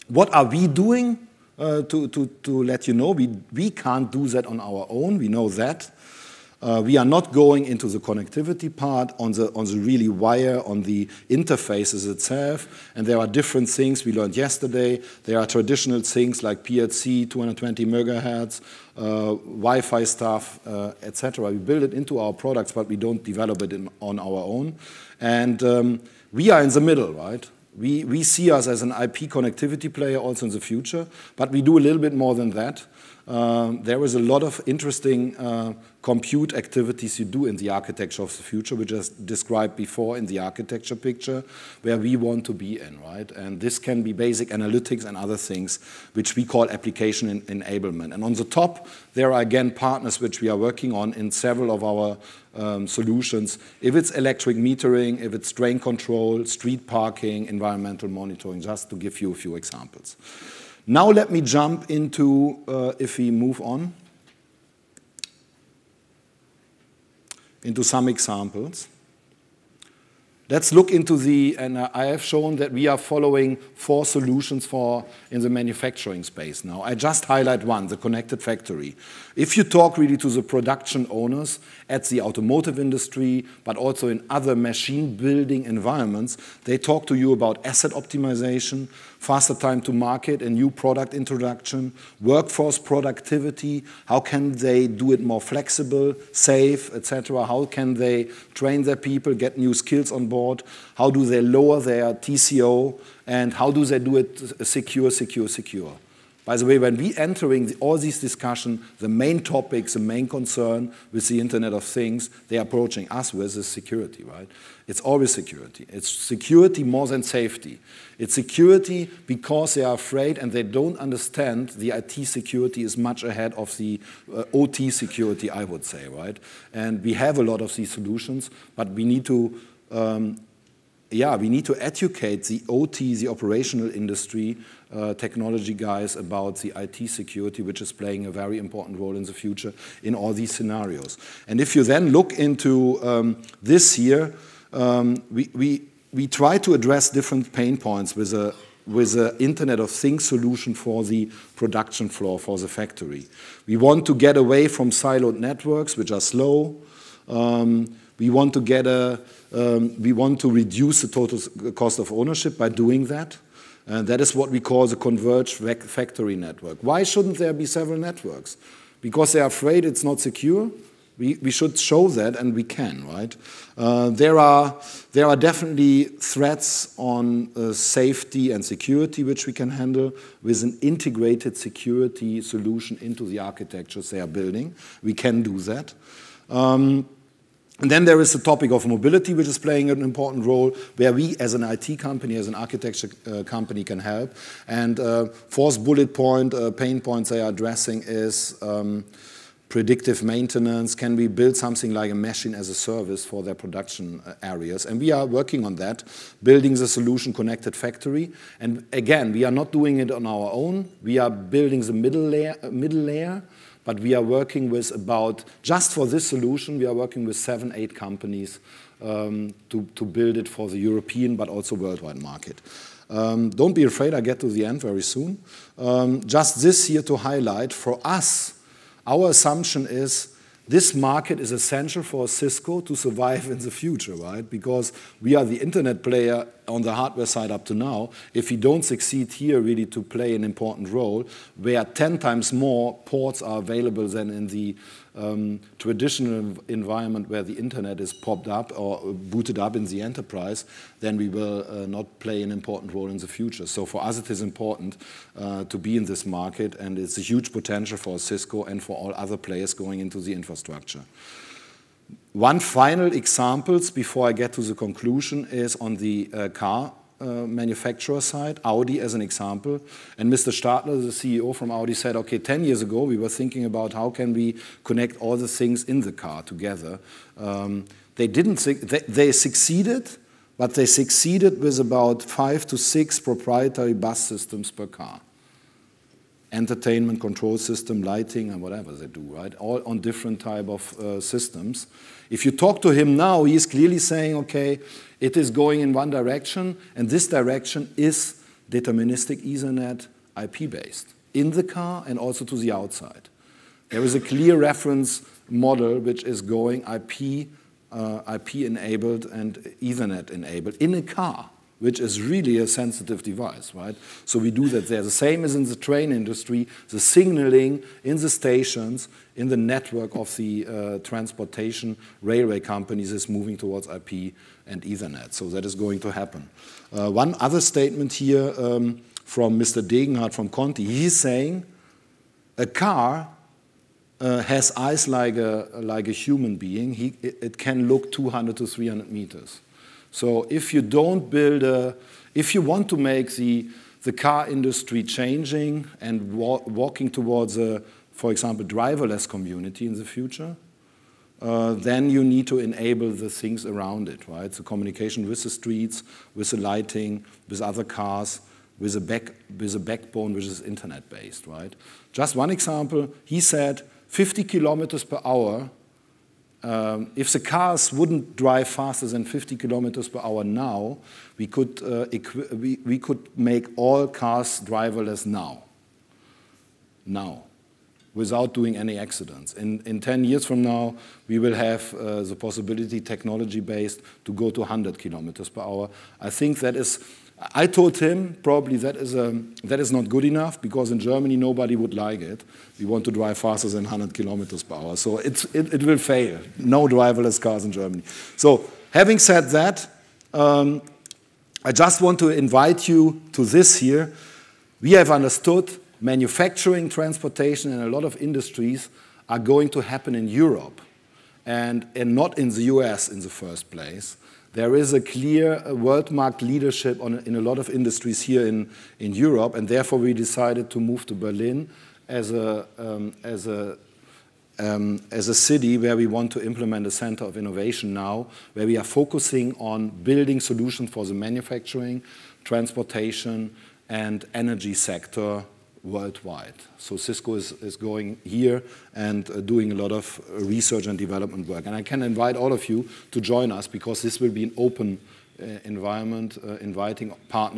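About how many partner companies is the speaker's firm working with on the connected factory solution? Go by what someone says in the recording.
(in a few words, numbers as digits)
seven, eight.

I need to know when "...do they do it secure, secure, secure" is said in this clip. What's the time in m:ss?
1:43.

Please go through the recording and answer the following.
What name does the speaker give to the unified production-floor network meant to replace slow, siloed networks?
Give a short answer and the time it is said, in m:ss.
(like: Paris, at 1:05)
converged factory network, at 2:44.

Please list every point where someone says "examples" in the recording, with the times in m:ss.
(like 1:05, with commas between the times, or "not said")
0:59, 1:08, 4:23, 4:29, 5:48, 6:02.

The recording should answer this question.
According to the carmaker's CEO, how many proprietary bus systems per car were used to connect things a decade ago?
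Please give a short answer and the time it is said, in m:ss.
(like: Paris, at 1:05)
5 to 6, at 4:42.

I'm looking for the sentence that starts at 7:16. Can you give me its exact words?
So Cisco is, is going here and uh, doing a lot of uh, research and development work.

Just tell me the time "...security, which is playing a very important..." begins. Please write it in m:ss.
2:17.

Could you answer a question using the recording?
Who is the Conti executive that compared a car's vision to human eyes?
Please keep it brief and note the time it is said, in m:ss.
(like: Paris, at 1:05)
Mr. Degenhart, at 5:29.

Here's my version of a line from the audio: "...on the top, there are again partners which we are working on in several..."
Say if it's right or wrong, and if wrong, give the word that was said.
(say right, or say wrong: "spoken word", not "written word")
right.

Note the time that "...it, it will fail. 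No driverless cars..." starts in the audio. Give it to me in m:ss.
6:35.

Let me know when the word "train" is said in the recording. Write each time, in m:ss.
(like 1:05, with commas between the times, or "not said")
1:38, 5:15.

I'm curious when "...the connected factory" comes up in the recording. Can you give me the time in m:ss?
1:17.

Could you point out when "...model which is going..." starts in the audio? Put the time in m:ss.
5:05.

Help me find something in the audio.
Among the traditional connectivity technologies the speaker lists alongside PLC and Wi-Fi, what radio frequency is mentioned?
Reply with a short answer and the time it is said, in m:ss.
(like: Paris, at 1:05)
220 megahertz, at 0:17.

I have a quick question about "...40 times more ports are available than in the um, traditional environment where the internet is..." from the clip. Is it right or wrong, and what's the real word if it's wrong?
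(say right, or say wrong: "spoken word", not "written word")
wrong: "10", not "40".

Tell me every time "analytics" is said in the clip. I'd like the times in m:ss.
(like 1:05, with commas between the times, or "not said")
0:44.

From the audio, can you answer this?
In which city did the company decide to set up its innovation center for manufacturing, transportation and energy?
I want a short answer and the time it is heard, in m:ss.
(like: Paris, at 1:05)
Berlin, at 7:01.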